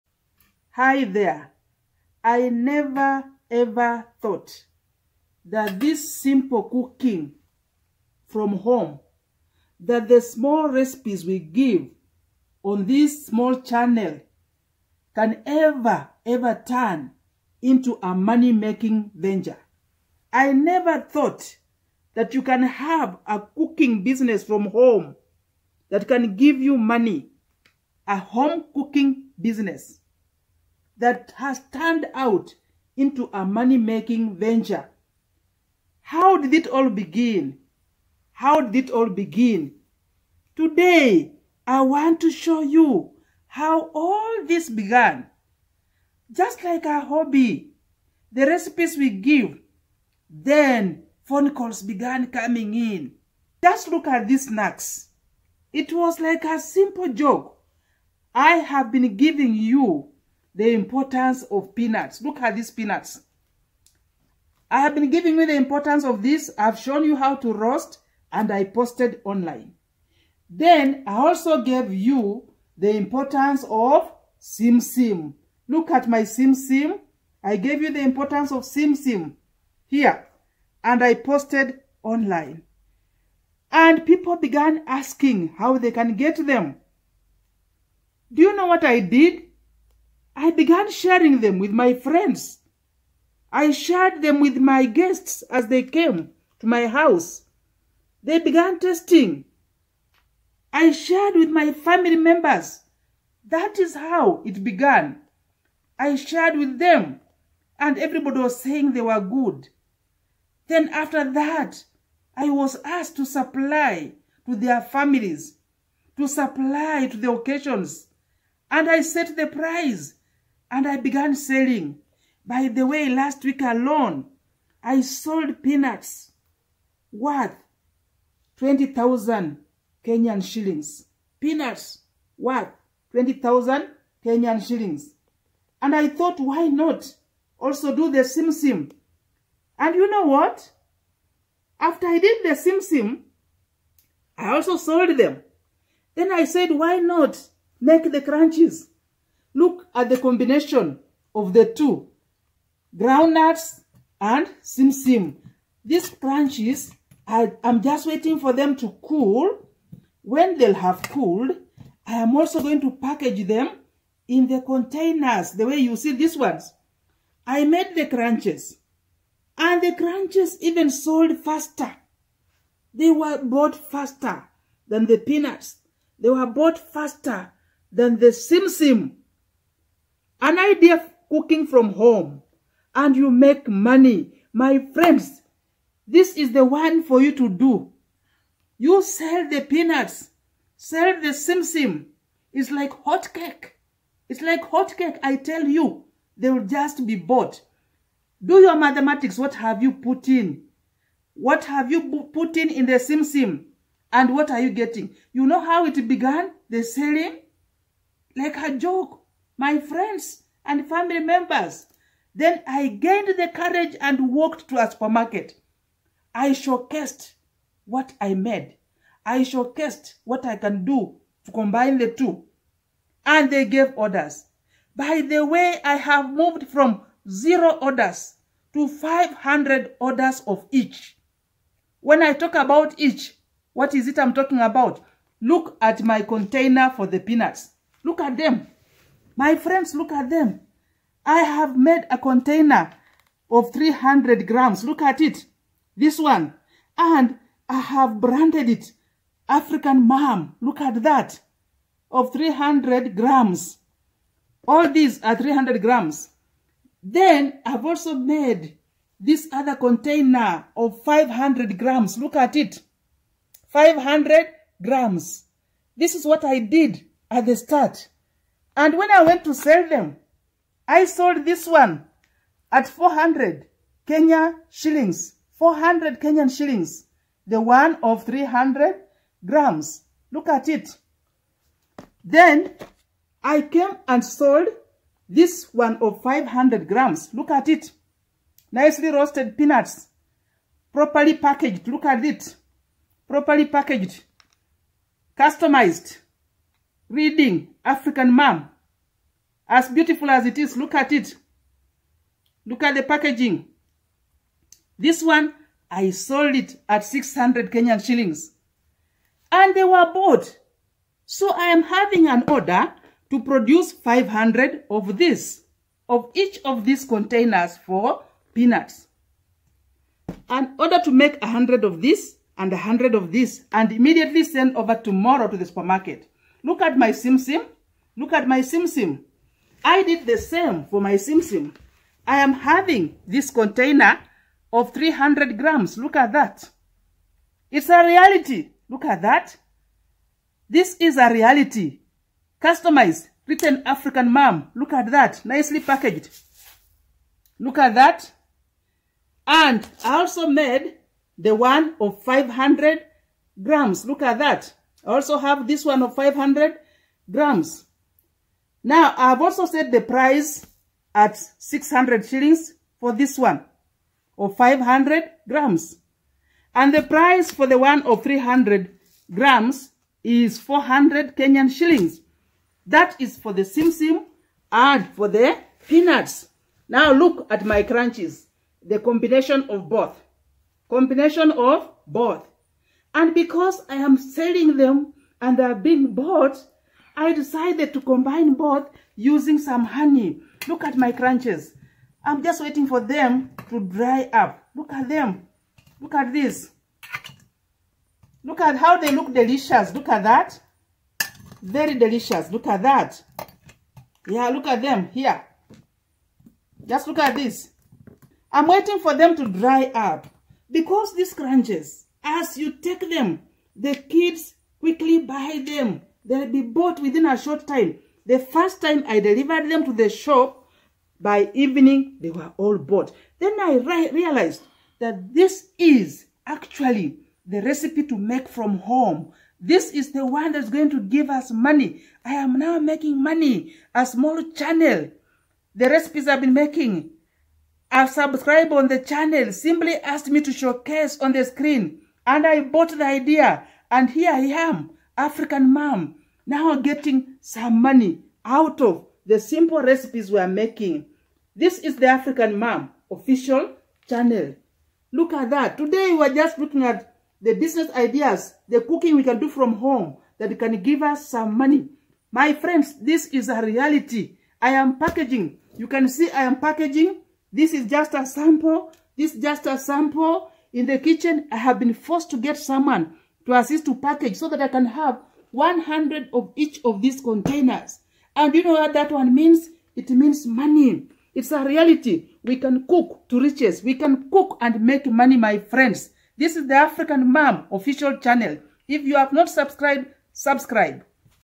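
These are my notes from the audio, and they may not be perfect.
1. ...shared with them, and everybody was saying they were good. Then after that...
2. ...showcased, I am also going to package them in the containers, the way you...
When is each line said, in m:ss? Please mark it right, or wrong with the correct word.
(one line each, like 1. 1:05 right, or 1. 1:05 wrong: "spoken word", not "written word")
1. 1:46 right
2. 2:41 wrong: "cooled", not "showcased".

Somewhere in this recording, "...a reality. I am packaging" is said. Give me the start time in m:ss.
7:43.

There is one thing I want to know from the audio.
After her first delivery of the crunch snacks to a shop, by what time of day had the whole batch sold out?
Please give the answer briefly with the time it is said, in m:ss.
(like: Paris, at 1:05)
By evening, at 7:01.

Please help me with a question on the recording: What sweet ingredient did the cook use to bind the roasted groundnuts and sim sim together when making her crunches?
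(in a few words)
Honey.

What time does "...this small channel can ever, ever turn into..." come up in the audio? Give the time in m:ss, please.
0:12.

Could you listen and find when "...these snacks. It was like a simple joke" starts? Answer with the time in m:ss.
0:54.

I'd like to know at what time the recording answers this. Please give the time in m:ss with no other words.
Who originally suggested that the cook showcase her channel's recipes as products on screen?
7:17.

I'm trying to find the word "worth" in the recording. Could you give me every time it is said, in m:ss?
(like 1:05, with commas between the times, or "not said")
2:07, 2:12.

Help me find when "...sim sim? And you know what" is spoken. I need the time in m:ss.
2:18.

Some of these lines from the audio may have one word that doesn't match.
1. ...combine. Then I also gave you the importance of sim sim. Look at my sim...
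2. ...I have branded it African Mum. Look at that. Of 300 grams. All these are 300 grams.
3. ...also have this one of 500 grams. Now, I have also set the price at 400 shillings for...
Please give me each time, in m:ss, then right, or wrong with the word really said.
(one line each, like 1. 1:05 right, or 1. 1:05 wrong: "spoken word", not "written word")
1. 1:09 wrong: "online", not "combine"
2. 4:07 right
3. 5:55 wrong: "600", not "400".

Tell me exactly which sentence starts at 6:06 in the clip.
And the price for the one of 300 grams is 400 Kenyan shillings.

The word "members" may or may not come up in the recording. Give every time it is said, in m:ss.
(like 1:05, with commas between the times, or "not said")
1:42, 3:31.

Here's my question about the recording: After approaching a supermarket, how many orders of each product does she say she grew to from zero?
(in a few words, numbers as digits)
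500 orders.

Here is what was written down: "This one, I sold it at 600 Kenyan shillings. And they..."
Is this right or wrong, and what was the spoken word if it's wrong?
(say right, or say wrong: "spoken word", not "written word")
right.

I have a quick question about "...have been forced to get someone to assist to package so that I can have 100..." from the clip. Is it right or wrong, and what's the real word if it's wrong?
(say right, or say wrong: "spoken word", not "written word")
right.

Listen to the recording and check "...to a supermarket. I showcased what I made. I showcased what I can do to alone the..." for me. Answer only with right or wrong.
wrong.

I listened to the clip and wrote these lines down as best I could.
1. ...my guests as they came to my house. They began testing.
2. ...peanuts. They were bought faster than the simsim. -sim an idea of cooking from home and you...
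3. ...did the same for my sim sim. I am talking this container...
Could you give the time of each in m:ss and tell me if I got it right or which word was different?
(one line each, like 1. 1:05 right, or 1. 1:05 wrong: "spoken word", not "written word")
1. 1:34 right
2. 2:55 right
3. 5:30 wrong: "having", not "talking".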